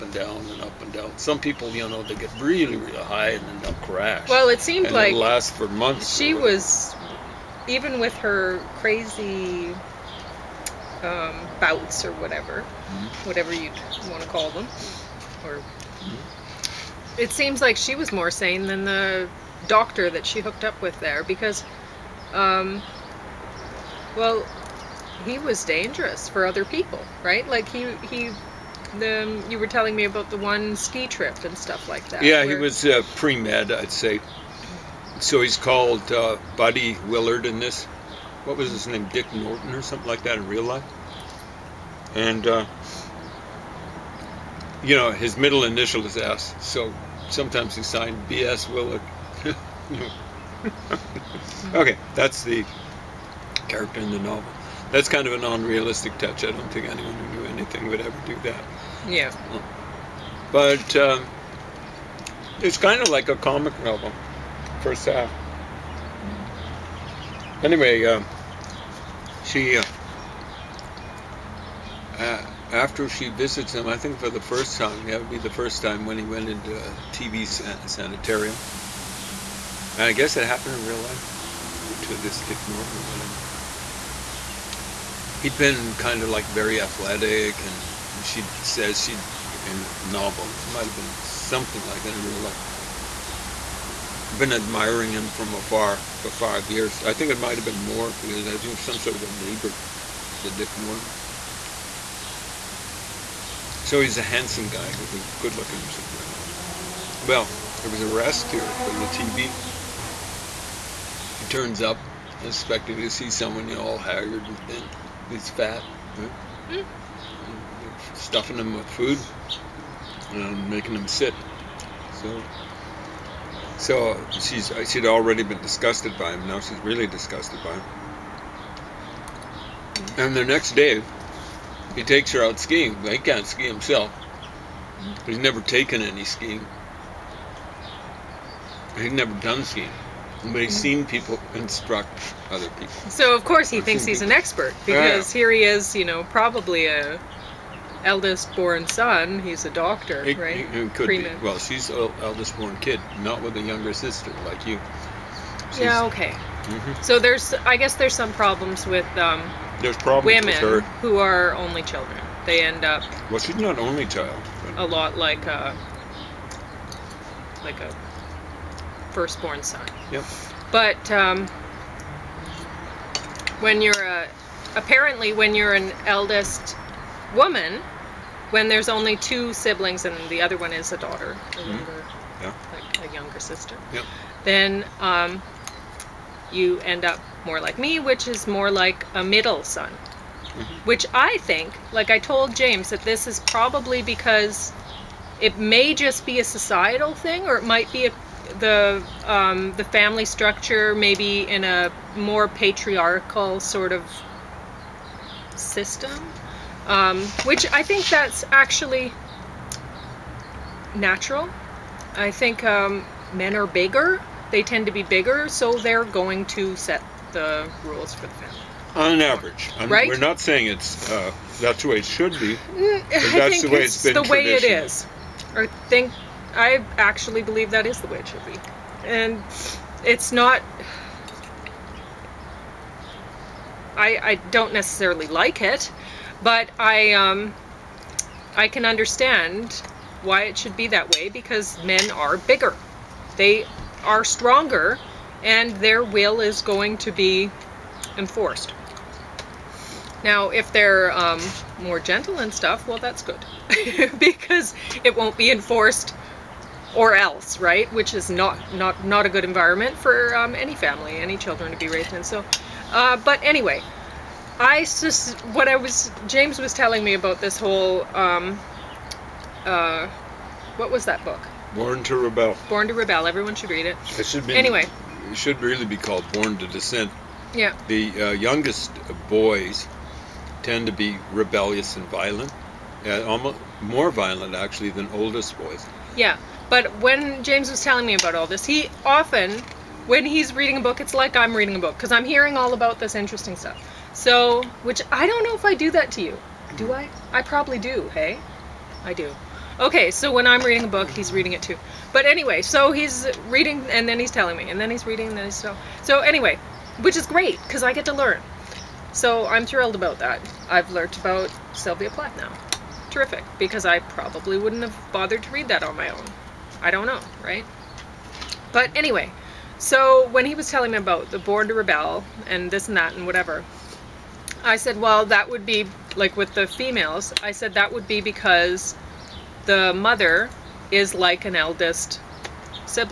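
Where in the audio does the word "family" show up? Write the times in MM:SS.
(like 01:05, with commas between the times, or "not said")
03:19, 03:38, 04:20.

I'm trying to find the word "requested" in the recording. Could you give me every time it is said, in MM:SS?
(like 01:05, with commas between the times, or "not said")
not said.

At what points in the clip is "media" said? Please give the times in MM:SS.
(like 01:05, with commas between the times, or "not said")
not said.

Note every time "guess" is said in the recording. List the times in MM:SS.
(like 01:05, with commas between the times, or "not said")
01:20, 02:37.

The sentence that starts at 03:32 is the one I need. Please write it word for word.
I think um, men are bigger.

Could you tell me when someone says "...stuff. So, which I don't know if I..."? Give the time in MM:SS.
04:53.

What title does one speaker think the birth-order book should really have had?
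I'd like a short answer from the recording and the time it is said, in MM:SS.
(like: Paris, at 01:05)
Born to Dissent, at 04:36.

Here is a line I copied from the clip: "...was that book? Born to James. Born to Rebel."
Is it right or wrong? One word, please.
wrong.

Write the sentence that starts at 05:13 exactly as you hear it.
Terrific, because I probably wouldn't have bothered to read that on my own.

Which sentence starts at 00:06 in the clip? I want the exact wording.
She was even with her crazy um, bouts or whatever, mm-hmm.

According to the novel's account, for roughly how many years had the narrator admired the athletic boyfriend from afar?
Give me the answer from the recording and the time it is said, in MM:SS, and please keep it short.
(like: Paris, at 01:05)
5 years, at 01:36.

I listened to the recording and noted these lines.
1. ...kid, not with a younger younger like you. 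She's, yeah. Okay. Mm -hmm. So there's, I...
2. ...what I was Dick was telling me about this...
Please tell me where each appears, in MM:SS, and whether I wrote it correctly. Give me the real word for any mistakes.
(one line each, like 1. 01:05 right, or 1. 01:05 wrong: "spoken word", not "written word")
1. 02:32 wrong: "sister", not "younger"
2. 04:25 wrong: "James", not "Dick".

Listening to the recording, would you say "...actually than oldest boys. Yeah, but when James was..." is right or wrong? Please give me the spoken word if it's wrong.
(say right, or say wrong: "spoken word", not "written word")
right.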